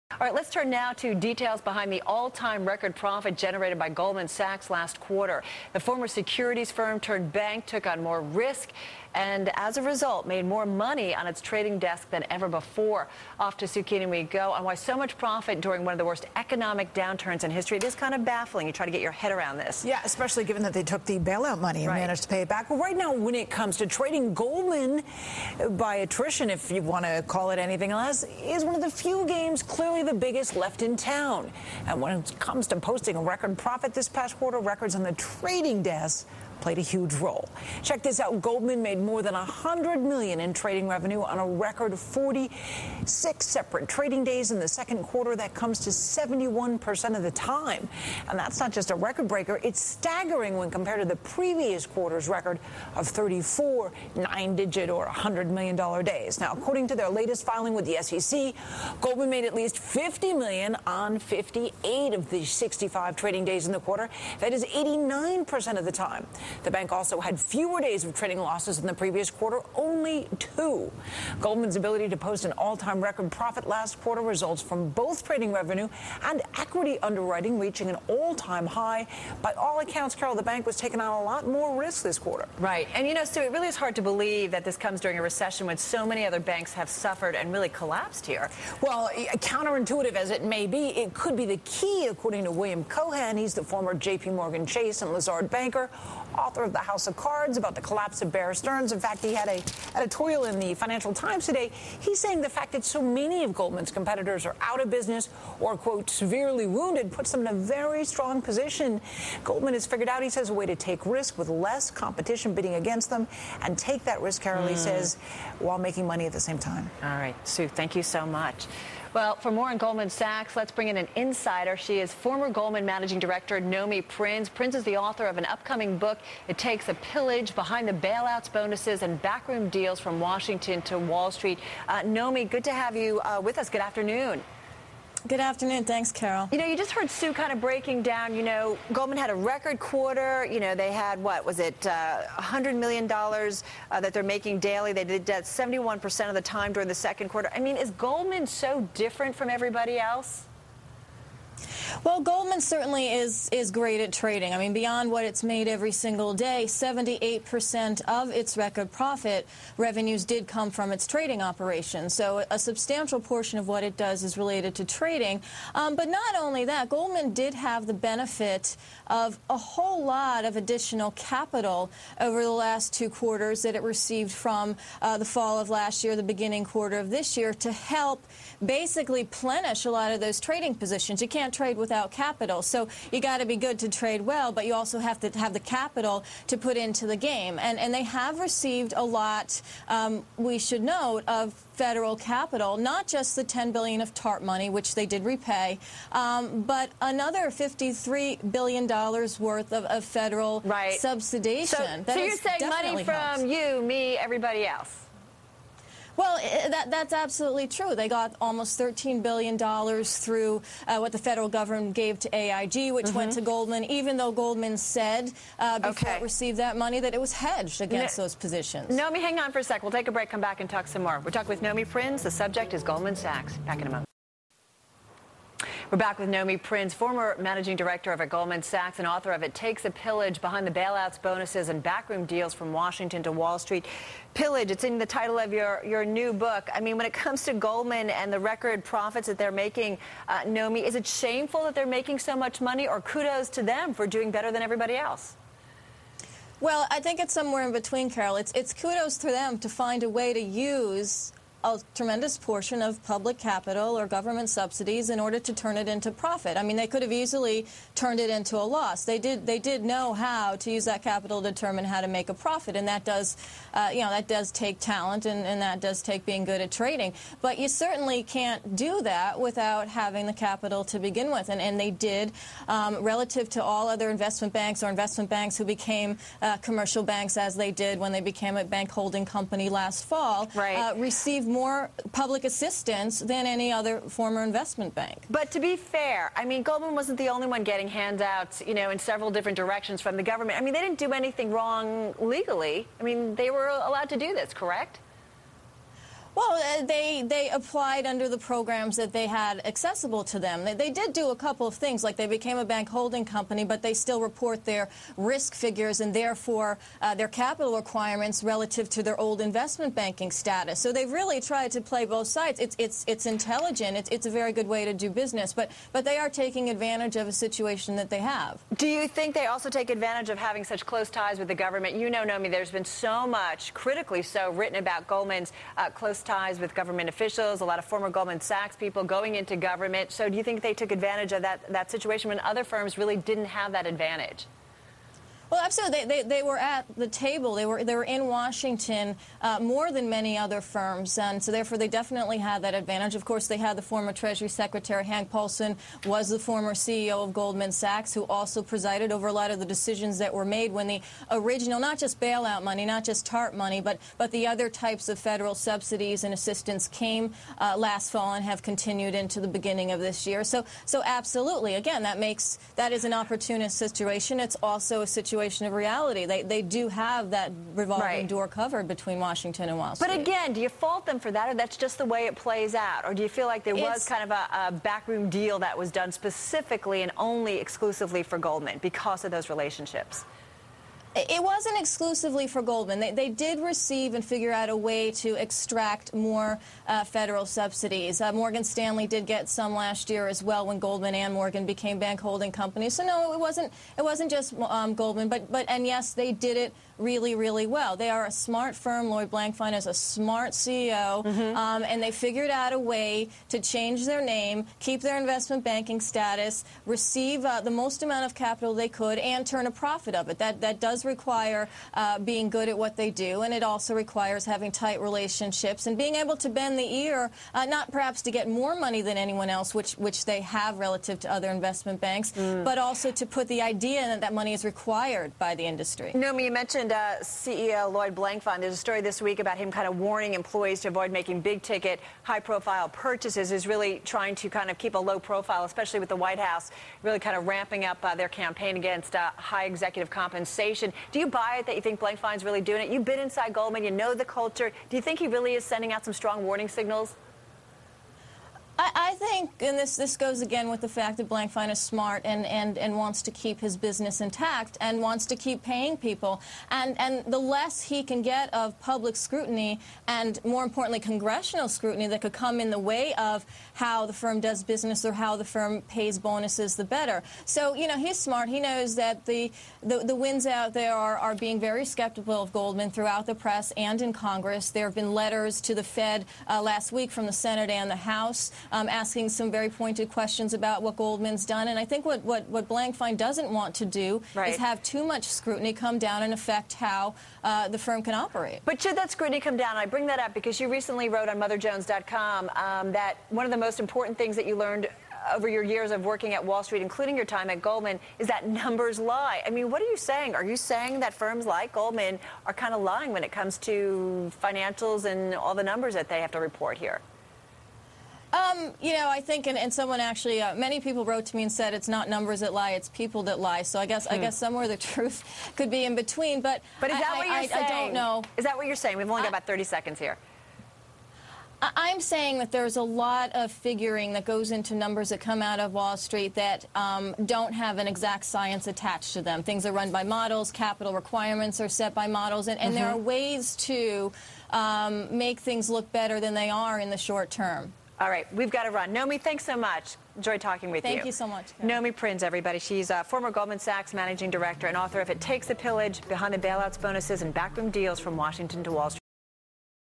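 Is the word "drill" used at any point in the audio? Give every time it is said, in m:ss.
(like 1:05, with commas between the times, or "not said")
not said.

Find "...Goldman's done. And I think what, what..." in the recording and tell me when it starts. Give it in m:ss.
8:00.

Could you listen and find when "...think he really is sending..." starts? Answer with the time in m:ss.
7:25.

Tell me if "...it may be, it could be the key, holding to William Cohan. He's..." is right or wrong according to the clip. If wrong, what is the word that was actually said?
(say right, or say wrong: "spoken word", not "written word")
wrong: "according", not "holding".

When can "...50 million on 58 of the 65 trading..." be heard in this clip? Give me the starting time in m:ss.
0:59.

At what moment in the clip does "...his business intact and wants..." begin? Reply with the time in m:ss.
7:33.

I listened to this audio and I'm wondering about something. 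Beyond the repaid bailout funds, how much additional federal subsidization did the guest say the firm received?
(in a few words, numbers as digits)
$53 billion.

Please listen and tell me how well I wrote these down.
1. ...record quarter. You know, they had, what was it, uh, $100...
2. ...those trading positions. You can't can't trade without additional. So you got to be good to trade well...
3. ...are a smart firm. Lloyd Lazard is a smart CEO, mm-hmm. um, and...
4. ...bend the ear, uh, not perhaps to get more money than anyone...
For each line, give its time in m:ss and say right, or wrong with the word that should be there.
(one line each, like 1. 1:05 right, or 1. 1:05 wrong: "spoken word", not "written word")
1. 2:19 right
2. 3:00 wrong: "capital", not "additional"
3. 6:38 wrong: "Blankfein", not "Lazard"
4. 6:56 right.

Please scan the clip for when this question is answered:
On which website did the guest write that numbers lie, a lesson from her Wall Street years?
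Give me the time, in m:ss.
8:11.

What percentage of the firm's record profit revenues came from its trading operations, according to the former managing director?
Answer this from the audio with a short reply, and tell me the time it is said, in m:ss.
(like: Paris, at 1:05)
78%, at 2:36.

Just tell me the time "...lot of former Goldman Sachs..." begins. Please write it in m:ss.
5:27.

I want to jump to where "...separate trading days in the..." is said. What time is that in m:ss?
0:43.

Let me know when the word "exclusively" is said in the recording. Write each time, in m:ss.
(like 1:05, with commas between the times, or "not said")
6:17, 6:21.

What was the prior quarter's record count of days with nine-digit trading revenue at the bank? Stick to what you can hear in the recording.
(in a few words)
34.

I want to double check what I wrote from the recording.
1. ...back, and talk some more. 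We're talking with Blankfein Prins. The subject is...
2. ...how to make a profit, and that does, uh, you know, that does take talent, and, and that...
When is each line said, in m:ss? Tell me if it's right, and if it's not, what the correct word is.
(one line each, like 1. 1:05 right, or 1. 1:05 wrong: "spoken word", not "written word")
1. 3:40 wrong: "Nomi", not "Blankfein"
2. 4:21 right.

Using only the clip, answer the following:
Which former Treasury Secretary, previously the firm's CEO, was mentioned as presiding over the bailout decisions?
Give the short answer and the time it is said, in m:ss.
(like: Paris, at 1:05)
Hank Paulson, at 5:45.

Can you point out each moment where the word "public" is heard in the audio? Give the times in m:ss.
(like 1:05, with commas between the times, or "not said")
4:13, 4:42, 7:38.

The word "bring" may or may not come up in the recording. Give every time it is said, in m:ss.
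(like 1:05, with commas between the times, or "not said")
2:00, 8:09.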